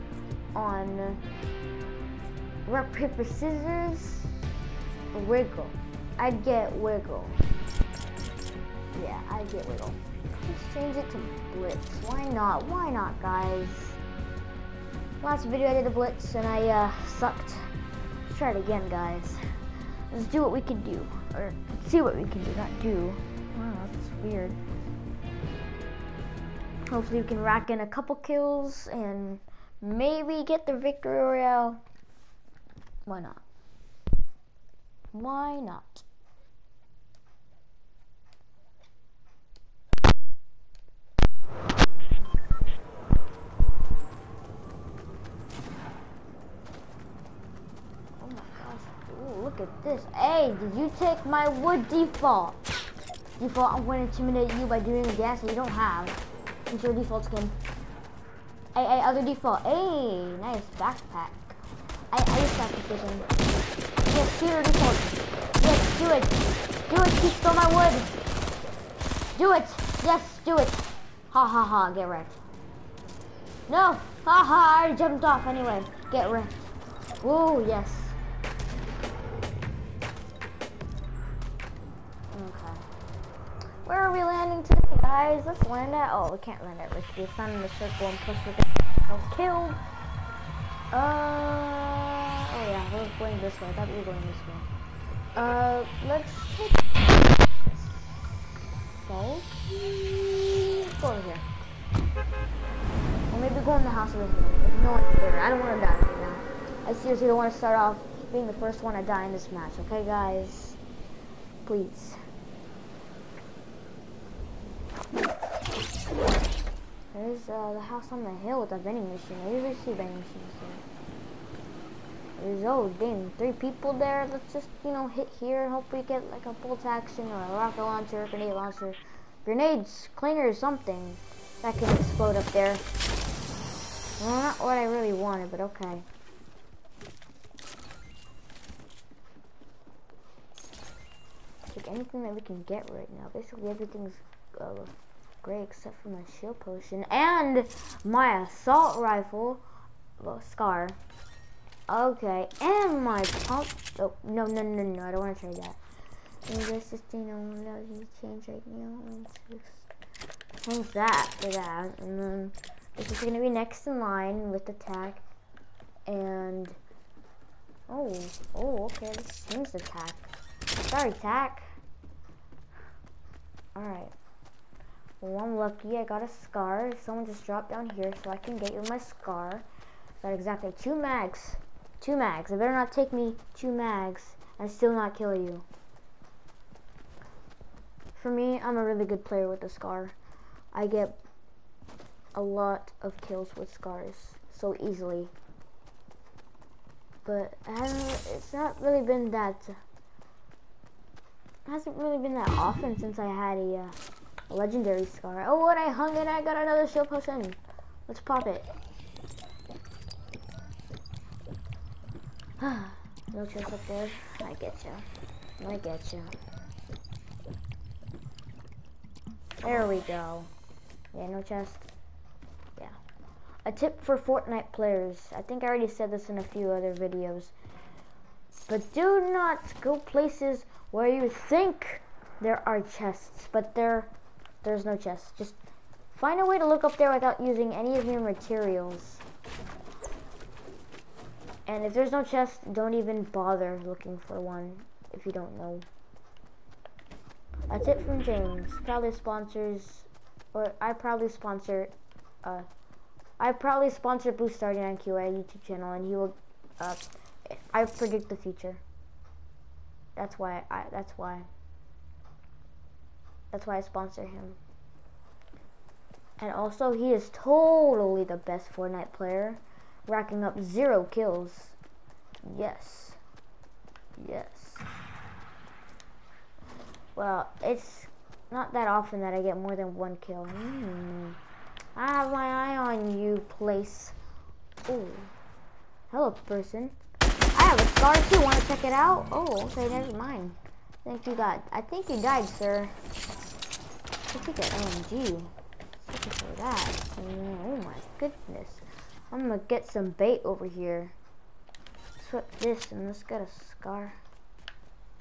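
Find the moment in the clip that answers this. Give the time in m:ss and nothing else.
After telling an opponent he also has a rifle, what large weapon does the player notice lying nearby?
4:54.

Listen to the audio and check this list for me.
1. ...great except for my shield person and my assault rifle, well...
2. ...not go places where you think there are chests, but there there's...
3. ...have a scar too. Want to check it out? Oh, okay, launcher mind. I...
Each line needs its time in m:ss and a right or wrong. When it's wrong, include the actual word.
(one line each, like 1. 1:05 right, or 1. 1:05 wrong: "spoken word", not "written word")
1. 2:25 wrong: "potion", not "person"
2. 3:49 right
3. 4:47 wrong: "never", not "launcher".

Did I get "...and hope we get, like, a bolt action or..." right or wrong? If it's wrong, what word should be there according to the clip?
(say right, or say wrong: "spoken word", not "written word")
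right.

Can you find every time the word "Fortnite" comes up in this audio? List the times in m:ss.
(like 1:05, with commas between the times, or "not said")
3:44, 4:28.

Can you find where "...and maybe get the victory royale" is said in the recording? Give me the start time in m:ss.
0:28.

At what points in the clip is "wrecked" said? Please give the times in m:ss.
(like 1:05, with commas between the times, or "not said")
1:12, 1:16.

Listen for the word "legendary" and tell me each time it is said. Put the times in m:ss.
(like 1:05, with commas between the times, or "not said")
3:24.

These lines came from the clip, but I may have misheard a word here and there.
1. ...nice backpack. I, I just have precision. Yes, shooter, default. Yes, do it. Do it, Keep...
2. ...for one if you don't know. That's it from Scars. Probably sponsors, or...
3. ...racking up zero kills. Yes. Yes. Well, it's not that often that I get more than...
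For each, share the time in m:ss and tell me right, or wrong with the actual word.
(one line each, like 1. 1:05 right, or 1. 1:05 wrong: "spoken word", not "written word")
1. 1:00 right
2. 4:04 wrong: "James", not "Scars"
3. 4:30 right.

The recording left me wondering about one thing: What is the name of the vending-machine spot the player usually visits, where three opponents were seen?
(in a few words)
House on the hill.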